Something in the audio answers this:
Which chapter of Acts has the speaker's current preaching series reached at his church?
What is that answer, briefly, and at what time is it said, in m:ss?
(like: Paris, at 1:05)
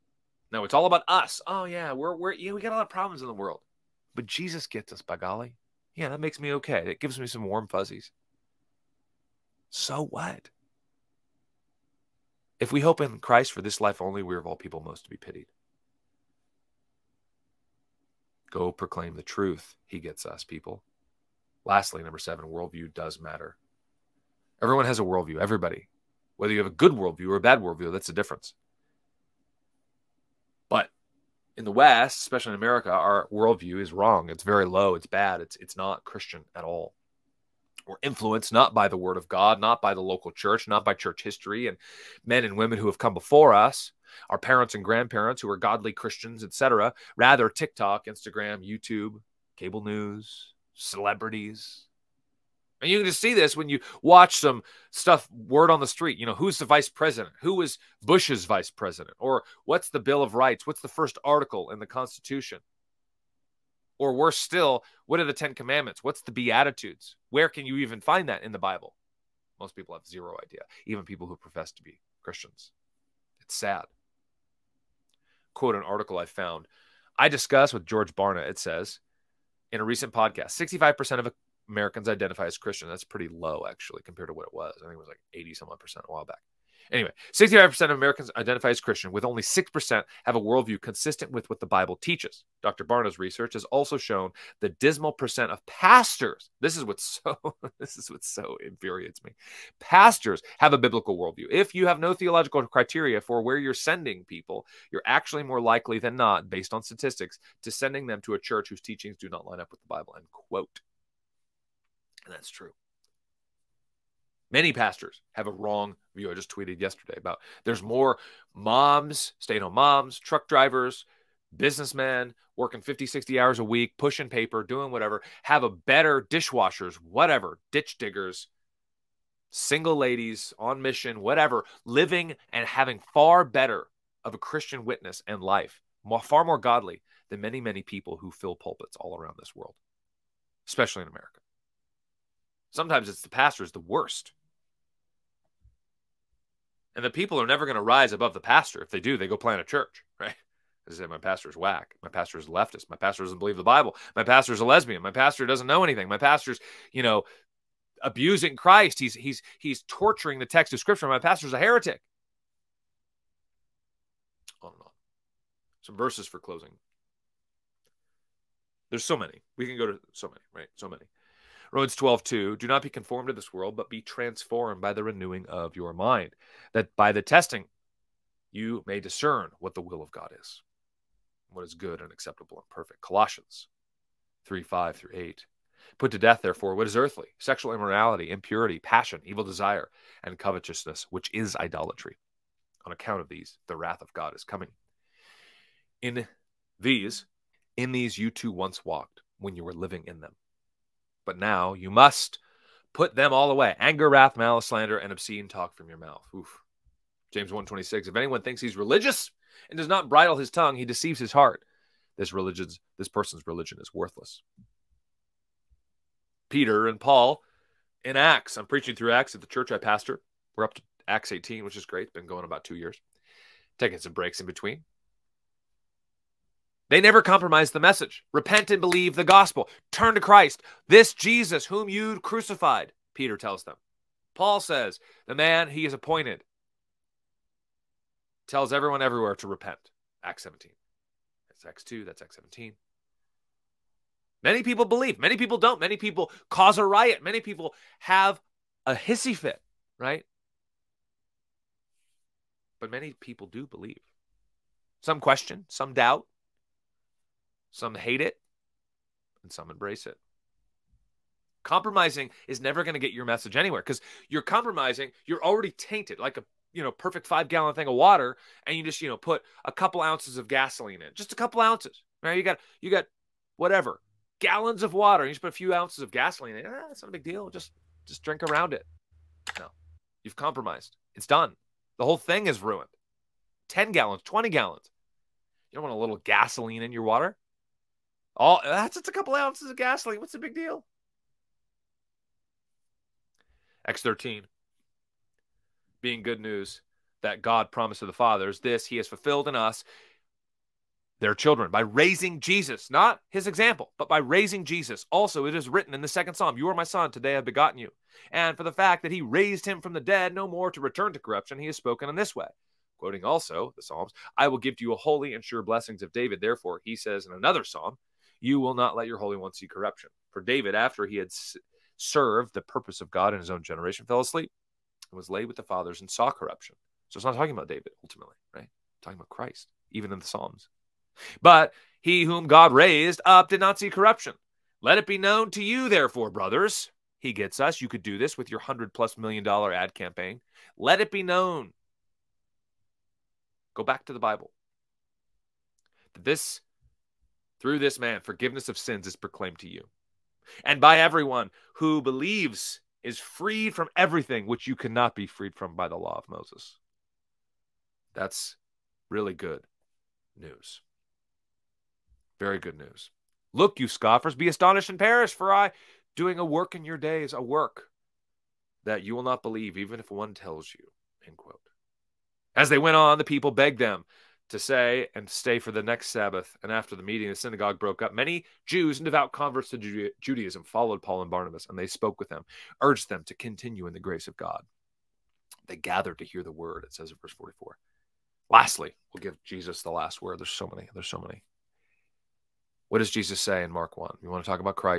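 Acts 18, at 3:41.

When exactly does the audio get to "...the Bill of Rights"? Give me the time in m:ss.
0:59.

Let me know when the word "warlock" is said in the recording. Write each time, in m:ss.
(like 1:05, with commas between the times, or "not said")
not said.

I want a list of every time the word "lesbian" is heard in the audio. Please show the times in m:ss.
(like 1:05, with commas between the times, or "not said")
2:34.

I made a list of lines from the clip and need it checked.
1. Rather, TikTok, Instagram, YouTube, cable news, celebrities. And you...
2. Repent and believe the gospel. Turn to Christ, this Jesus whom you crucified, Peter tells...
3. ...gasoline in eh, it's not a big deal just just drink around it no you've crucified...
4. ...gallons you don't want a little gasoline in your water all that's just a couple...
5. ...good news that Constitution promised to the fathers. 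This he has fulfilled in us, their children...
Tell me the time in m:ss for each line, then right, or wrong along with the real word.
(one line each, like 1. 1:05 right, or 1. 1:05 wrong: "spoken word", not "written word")
1. 0:47 right
2. 3:48 right
3. 4:36 wrong: "compromised", not "crucified"
4. 4:44 right
5. 4:56 wrong: "God", not "Constitution".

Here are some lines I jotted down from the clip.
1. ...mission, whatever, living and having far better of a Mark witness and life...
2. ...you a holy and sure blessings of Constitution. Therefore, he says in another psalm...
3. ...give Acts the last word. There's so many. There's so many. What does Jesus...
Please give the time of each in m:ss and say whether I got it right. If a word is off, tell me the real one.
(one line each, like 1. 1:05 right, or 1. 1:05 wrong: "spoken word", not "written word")
1. 2:10 wrong: "Christian", not "Mark"
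2. 5:14 wrong: "David", not "Constitution"
3. 6:29 wrong: "Jesus", not "Acts".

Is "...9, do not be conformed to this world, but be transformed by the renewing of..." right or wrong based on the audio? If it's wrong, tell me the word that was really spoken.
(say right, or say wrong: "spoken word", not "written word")
wrong: "2", not "9".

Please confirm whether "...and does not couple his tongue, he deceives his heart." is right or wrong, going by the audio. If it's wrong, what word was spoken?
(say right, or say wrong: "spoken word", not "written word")
wrong: "bridle", not "couple".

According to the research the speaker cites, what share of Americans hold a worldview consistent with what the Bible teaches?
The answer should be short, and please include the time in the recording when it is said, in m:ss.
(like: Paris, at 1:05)
6%, at 1:29.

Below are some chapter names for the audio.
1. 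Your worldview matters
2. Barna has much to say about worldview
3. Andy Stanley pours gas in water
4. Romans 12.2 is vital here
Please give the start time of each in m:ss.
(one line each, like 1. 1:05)
1. 0:17
2. 0:47
3. 4:30
4. 2:52.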